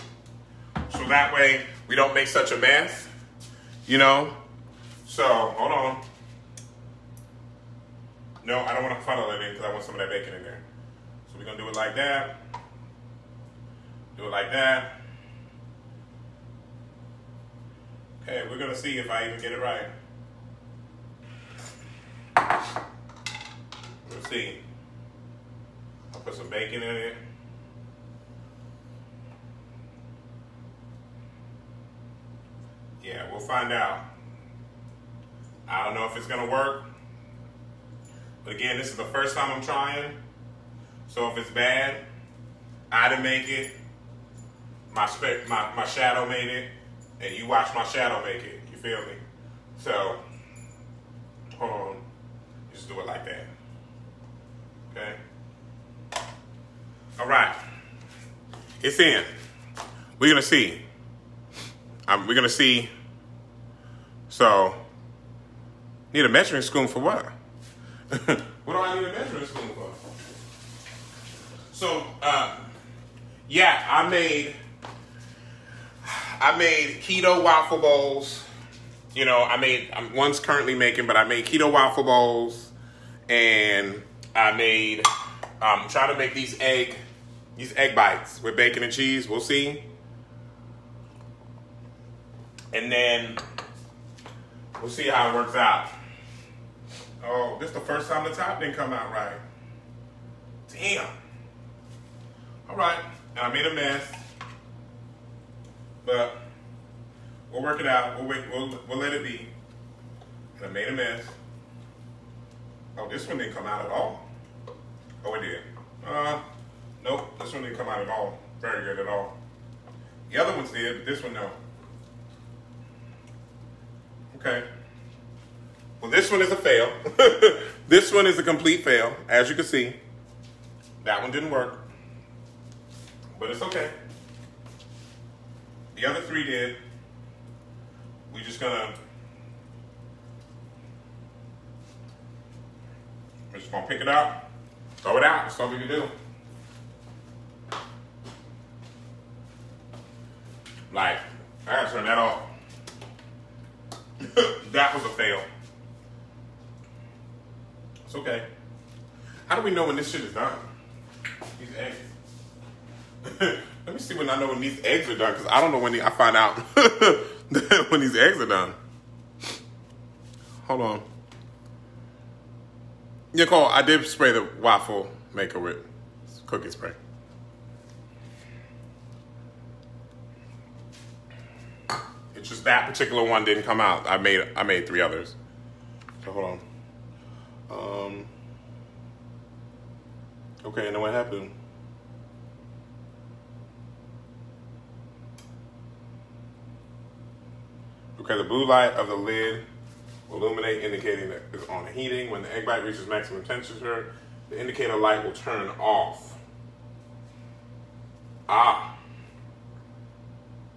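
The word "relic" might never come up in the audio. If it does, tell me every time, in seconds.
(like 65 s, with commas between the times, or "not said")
not said.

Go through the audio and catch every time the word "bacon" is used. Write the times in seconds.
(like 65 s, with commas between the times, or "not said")
10 s, 26 s, 88 s.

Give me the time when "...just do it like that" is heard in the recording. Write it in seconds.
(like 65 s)
52 s.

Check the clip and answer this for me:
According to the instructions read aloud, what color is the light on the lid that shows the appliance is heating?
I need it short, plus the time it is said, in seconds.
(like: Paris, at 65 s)
blue, at 198 s.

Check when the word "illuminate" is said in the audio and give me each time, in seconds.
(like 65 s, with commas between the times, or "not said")
200 s.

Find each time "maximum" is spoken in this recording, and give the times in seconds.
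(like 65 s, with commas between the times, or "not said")
203 s.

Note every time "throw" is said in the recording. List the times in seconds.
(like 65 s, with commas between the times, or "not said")
144 s.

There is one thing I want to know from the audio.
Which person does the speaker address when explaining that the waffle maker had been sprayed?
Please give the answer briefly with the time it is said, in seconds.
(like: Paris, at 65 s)
Nicole, at 173 s.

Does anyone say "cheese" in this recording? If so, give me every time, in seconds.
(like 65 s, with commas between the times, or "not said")
88 s.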